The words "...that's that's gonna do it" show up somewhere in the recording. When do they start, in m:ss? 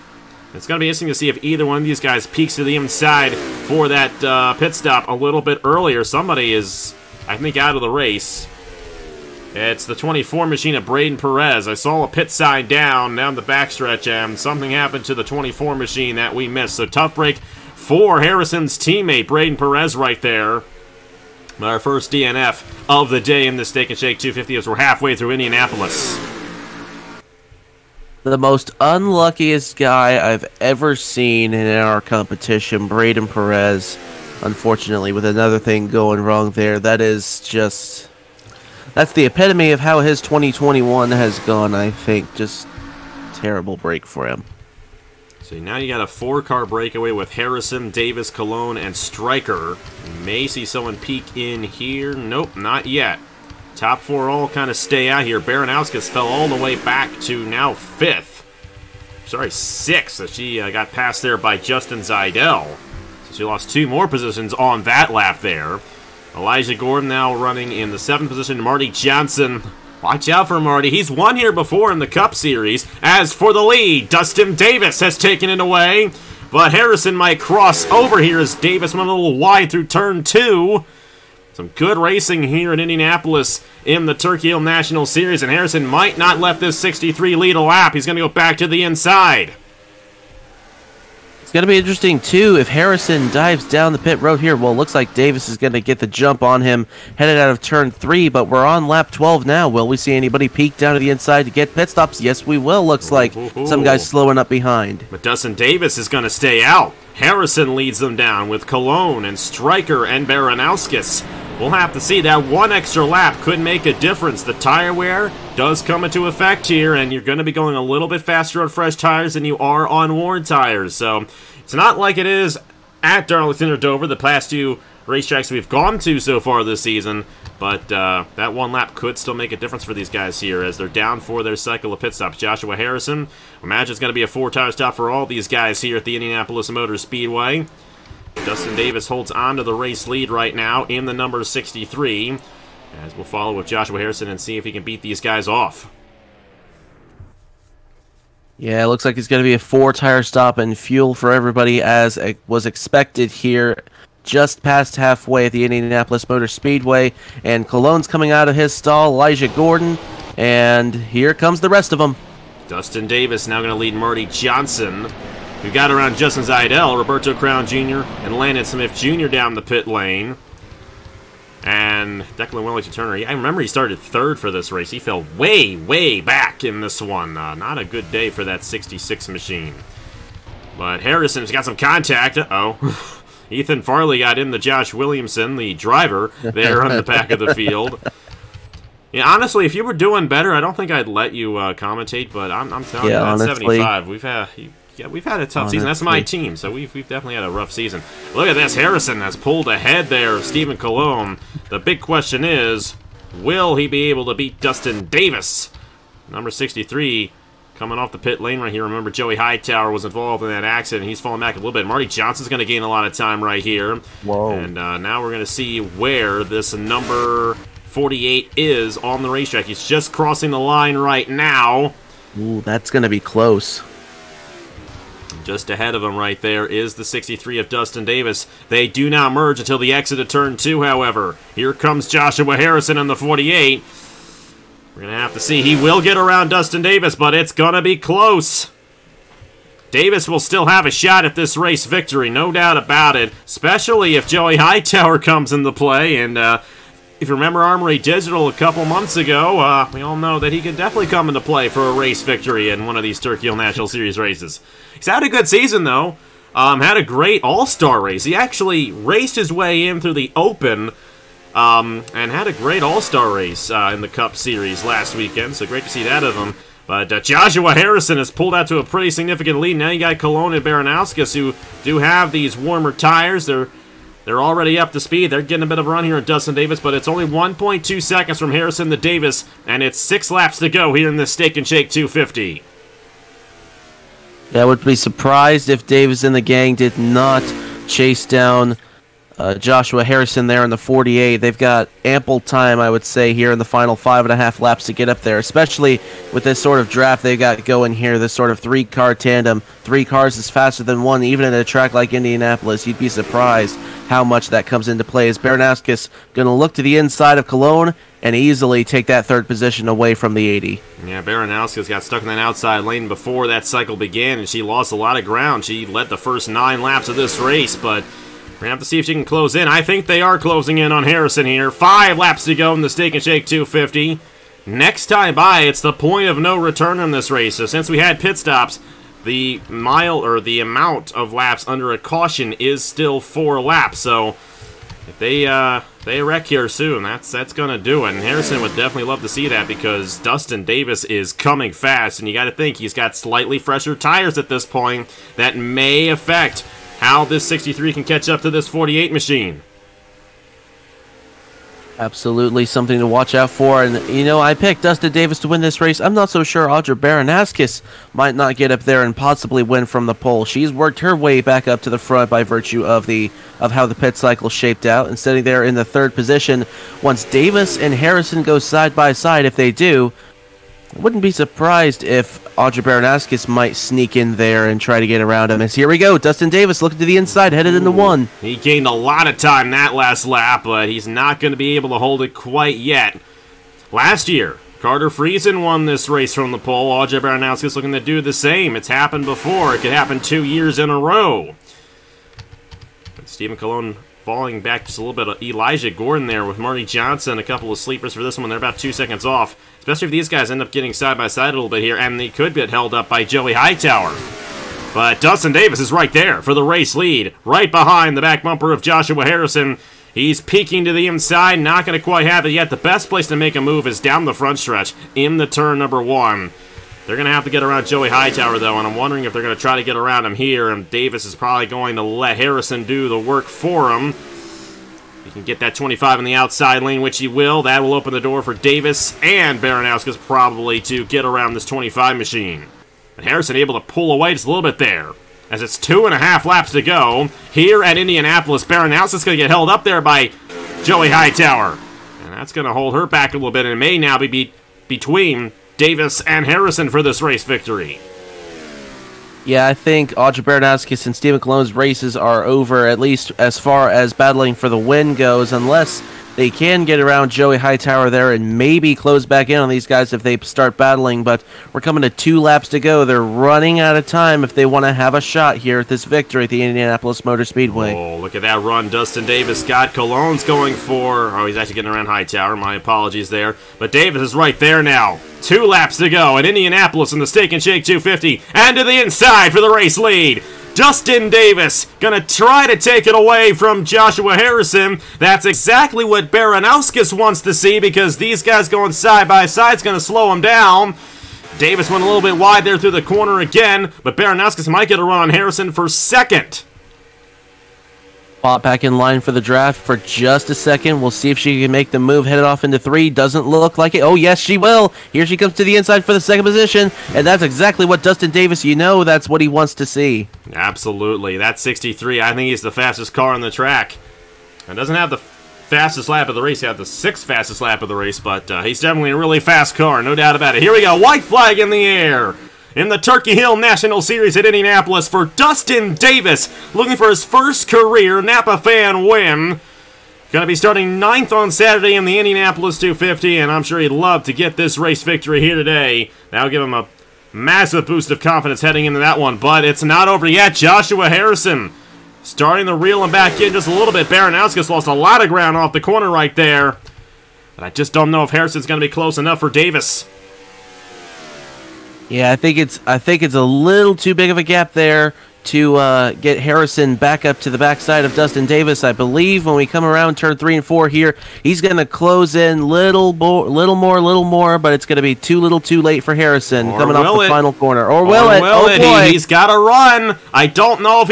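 5:37.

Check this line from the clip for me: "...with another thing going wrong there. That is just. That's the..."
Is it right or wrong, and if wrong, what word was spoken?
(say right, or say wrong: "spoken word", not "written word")
right.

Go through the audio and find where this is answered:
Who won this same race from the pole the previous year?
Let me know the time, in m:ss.
6:24.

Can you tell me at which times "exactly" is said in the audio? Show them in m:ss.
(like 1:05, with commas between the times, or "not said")
8:05, 8:27.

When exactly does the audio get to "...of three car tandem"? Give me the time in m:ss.
4:58.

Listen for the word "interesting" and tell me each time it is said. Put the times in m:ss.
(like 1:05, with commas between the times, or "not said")
0:00, 1:31.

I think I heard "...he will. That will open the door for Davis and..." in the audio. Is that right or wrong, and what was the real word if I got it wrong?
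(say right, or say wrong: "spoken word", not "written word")
right.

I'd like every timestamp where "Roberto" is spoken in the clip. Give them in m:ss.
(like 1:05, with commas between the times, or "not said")
2:46.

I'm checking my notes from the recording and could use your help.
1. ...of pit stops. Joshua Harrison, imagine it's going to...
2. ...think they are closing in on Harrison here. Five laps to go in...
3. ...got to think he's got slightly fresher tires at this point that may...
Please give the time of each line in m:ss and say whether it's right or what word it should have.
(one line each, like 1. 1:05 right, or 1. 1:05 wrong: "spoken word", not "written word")
1. 2:11 right
2. 5:19 right
3. 5:42 right.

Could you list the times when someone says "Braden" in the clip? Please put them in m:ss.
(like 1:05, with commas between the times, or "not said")
0:10, 0:19, 0:32.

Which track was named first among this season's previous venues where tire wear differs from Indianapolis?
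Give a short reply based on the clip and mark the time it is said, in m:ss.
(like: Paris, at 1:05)
Darlington, at 2:03.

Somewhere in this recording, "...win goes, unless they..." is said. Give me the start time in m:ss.
7:34.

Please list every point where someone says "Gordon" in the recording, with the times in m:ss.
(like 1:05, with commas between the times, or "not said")
1:06, 2:39, 6:35.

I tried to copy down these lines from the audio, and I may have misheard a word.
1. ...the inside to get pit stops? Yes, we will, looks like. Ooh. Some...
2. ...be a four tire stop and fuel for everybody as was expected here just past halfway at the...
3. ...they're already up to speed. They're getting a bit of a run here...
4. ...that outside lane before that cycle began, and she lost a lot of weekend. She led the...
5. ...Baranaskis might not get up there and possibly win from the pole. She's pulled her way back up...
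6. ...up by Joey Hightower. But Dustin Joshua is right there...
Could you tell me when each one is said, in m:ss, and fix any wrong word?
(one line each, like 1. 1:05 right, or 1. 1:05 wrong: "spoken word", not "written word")
1. 1:41 right
2. 2:29 right
3. 4:34 right
4. 5:12 wrong: "ground", not "weekend"
5. 5:56 wrong: "worked", not "pulled"
6. 6:42 wrong: "Davis", not "Joshua".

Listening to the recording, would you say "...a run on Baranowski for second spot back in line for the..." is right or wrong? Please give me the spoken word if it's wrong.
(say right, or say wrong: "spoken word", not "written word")
wrong: "Harrison", not "Baranowski".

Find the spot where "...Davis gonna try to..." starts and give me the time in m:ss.
8:01.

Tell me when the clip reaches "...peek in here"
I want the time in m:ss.
0:50.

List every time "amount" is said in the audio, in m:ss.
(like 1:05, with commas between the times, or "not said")
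5:30.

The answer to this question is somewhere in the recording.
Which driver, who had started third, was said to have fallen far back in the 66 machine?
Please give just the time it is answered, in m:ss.
2:52.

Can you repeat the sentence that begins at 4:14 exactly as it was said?
He's had a good season, though.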